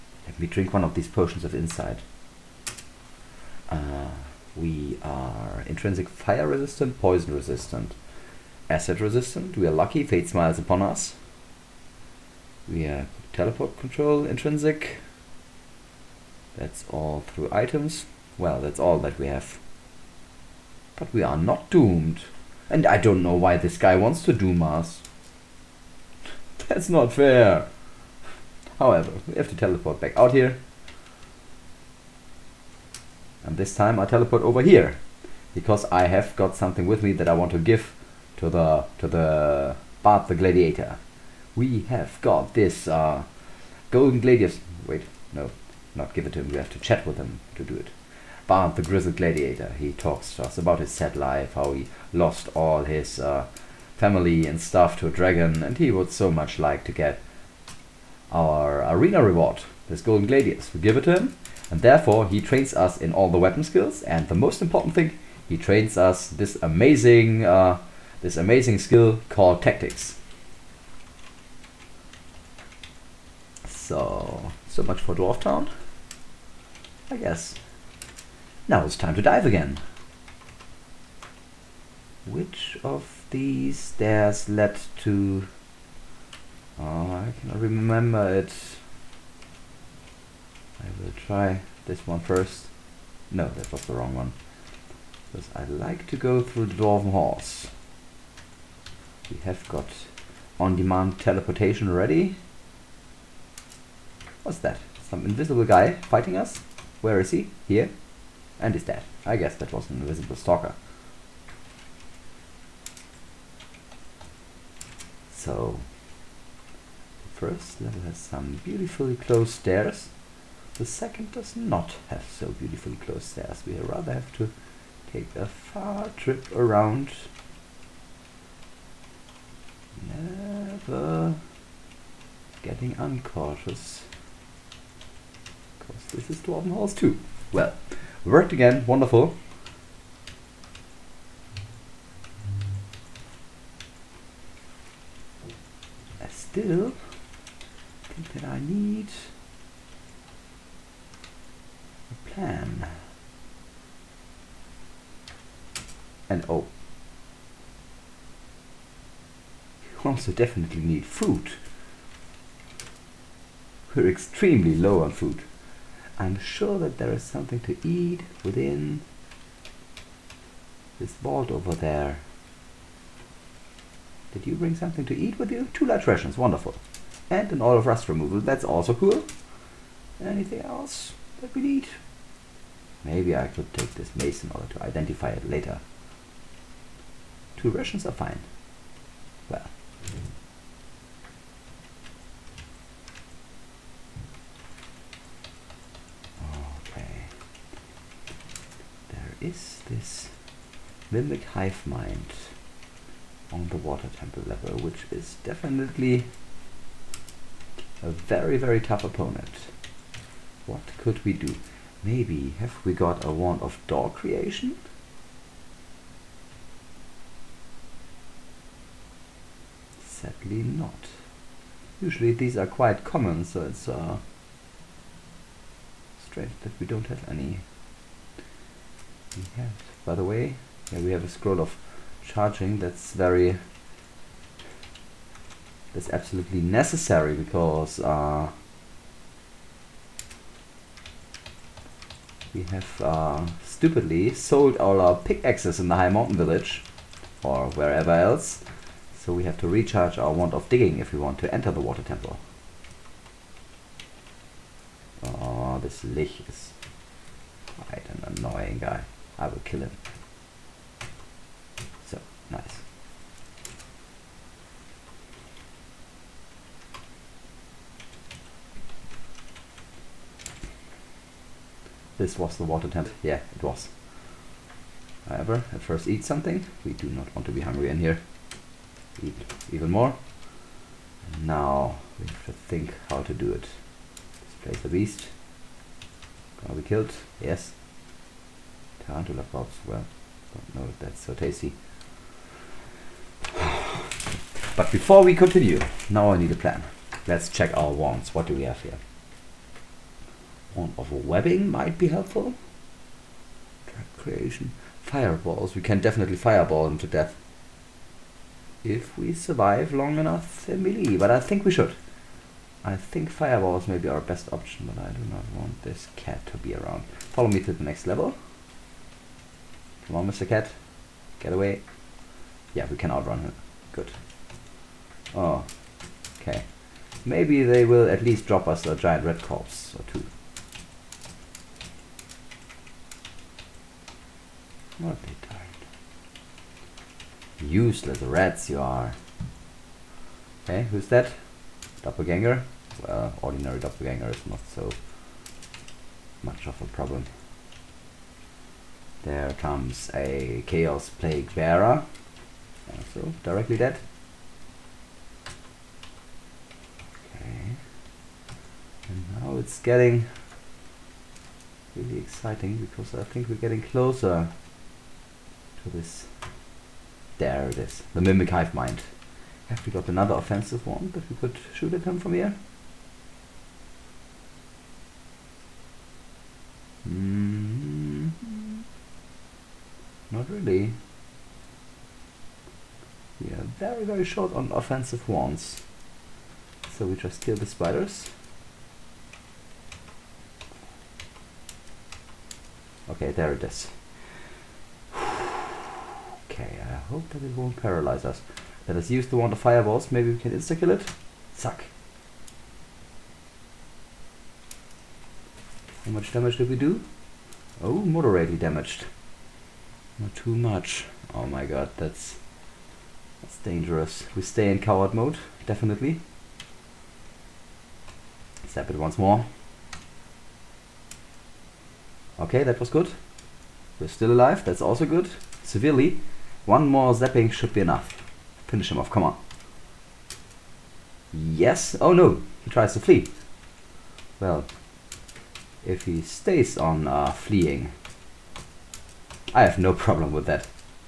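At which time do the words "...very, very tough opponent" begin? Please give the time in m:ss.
3:28.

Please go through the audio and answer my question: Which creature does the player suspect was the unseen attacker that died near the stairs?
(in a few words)
Invisible stalker.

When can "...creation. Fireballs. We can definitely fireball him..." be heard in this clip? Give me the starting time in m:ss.
5:04.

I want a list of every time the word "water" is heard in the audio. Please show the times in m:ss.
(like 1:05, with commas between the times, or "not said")
3:23, 4:11, 4:32.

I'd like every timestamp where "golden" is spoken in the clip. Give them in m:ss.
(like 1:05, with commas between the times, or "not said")
0:43, 0:59.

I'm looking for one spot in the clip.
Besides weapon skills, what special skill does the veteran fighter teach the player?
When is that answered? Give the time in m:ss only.
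1:09.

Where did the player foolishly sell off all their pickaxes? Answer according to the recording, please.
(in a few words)
High mountain village.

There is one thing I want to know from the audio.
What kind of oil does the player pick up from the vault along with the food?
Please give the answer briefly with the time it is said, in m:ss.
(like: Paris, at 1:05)
Oil of rust removal, at 2:57.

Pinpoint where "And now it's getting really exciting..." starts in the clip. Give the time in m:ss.
5:59.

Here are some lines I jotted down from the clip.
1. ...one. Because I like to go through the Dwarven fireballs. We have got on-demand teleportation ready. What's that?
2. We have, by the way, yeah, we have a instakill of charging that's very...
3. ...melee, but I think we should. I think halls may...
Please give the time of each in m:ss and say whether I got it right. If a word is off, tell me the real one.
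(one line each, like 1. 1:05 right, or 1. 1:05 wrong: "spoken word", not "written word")
1. 1:34 wrong: "halls", not "fireballs"
2. 3:49 wrong: "scroll", not "instakill"
3. 5:10 wrong: "fireballs", not "halls".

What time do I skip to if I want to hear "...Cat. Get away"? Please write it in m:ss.
5:20.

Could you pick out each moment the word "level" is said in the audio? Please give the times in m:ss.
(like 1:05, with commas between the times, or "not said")
1:57, 3:24, 5:18.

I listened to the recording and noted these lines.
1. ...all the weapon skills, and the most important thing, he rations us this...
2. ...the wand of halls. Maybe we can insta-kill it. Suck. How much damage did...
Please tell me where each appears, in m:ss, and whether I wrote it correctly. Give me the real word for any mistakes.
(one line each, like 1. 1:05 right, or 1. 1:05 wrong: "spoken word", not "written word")
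1. 1:03 wrong: "trains", not "rations"
2. 6:39 wrong: "fireballs", not "halls".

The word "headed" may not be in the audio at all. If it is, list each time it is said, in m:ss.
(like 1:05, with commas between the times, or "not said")
not said.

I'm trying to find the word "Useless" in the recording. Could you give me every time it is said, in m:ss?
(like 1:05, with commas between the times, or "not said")
5:37.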